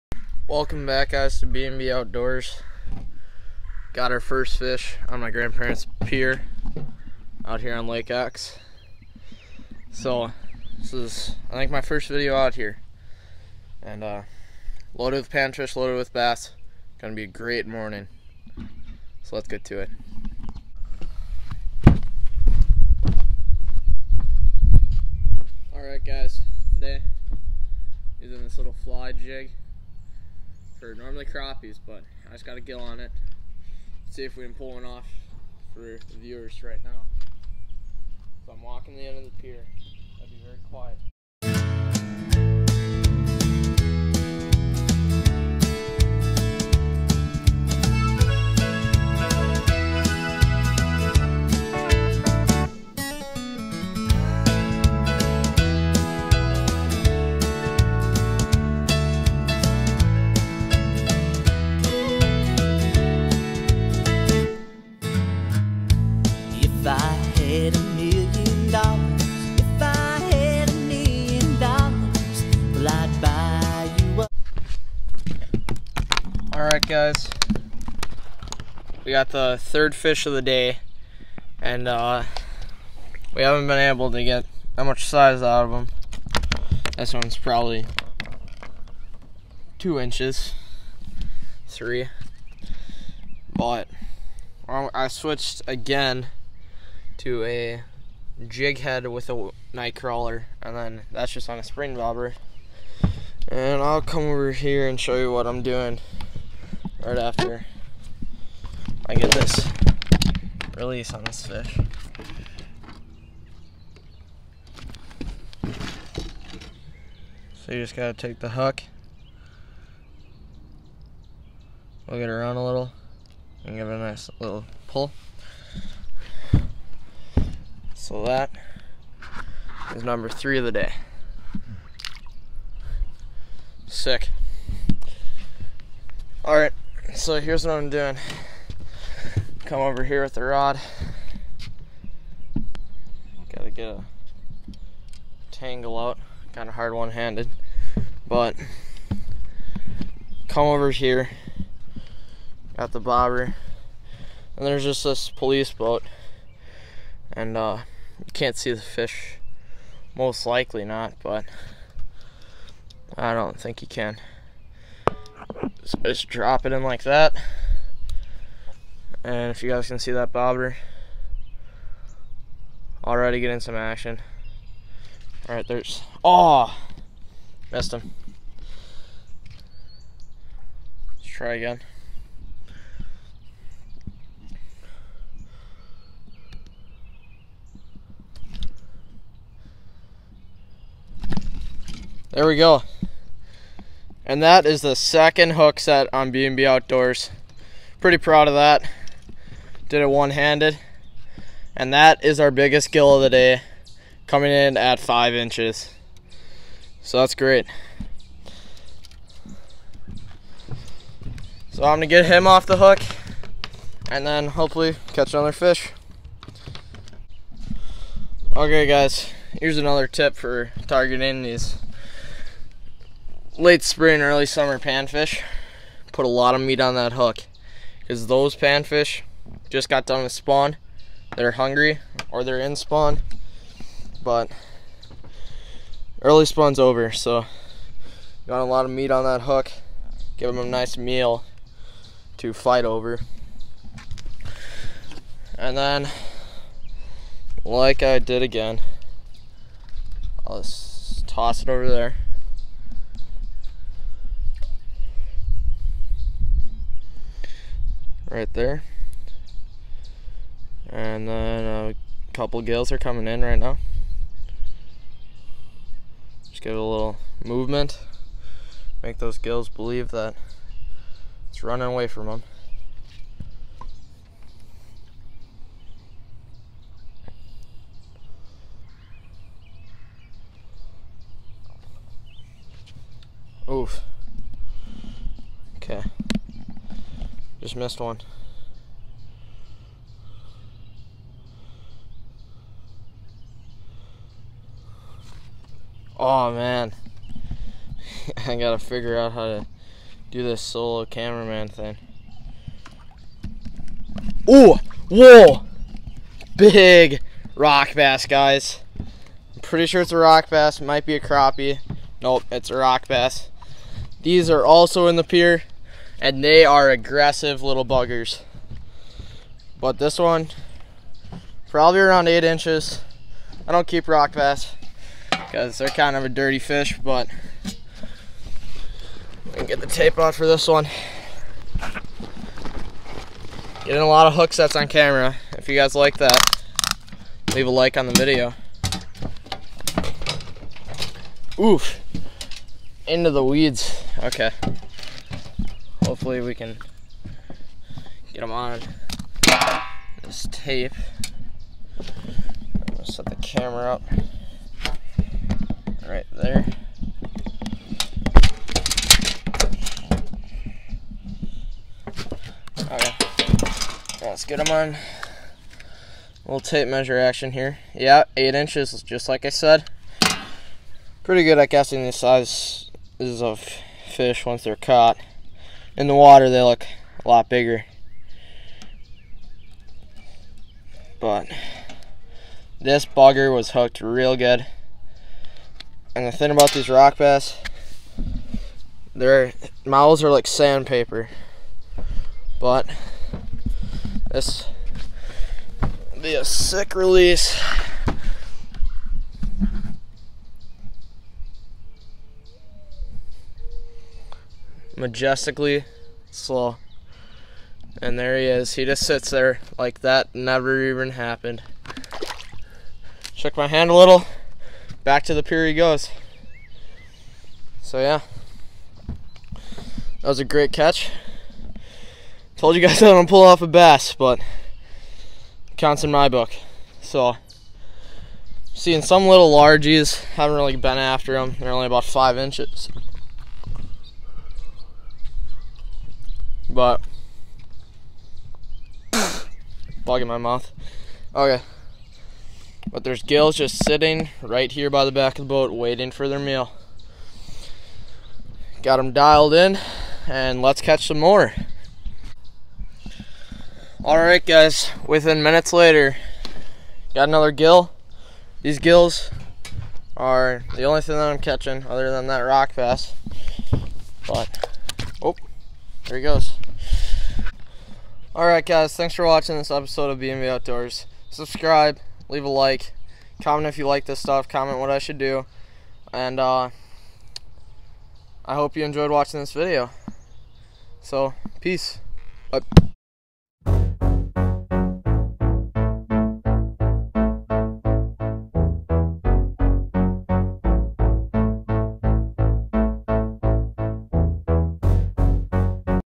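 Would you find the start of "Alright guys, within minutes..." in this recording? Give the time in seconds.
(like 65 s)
454 s.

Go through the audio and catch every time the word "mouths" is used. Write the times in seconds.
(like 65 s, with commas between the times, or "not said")
389 s, 440 s.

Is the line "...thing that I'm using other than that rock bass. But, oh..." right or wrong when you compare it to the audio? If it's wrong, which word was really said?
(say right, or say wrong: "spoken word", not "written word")
wrong: "catching", not "using".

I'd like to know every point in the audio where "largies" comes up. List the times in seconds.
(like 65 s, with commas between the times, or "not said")
429 s.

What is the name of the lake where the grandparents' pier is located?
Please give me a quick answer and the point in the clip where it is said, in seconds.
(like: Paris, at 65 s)
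Lake Ox, at 7 s.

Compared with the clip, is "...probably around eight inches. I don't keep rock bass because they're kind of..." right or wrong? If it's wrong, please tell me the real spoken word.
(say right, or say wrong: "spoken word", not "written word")
right.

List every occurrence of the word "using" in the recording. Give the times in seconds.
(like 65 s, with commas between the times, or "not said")
28 s.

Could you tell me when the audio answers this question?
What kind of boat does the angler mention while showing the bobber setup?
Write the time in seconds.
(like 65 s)
155 s.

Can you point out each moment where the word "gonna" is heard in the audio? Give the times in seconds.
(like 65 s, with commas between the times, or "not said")
16 s, 211 s.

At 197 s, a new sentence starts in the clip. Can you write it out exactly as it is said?
Pretty proud of that did it one-handed.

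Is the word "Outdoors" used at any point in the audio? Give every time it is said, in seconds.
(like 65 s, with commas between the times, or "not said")
1 s, 196 s, 470 s.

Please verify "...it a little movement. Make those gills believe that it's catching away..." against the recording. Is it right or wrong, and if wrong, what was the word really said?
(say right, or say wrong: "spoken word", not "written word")
wrong: "running", not "catching".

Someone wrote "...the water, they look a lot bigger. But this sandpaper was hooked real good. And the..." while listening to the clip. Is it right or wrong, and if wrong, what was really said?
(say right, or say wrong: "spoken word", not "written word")
wrong: "bugger", not "sandpaper".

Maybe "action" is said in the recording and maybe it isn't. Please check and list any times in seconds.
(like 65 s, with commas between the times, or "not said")
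173 s, 367 s.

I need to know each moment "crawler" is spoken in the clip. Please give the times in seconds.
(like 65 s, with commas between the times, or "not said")
99 s.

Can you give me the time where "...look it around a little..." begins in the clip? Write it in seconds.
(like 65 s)
122 s.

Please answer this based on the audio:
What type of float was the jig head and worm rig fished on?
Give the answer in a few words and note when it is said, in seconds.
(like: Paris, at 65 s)
Spring bobber, at 101 s.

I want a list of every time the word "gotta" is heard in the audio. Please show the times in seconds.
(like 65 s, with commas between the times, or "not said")
117 s, 143 s, 298 s.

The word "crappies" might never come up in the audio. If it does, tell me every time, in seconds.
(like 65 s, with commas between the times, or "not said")
31 s, 311 s.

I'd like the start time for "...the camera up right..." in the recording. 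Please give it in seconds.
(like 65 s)
353 s.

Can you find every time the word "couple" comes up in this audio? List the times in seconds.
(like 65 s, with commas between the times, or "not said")
262 s.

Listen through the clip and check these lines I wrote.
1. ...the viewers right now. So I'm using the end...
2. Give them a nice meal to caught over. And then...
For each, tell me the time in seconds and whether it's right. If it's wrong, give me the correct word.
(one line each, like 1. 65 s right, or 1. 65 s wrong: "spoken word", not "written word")
1. 36 s wrong: "walking", not "using"
2. 240 s wrong: "fight", not "caught".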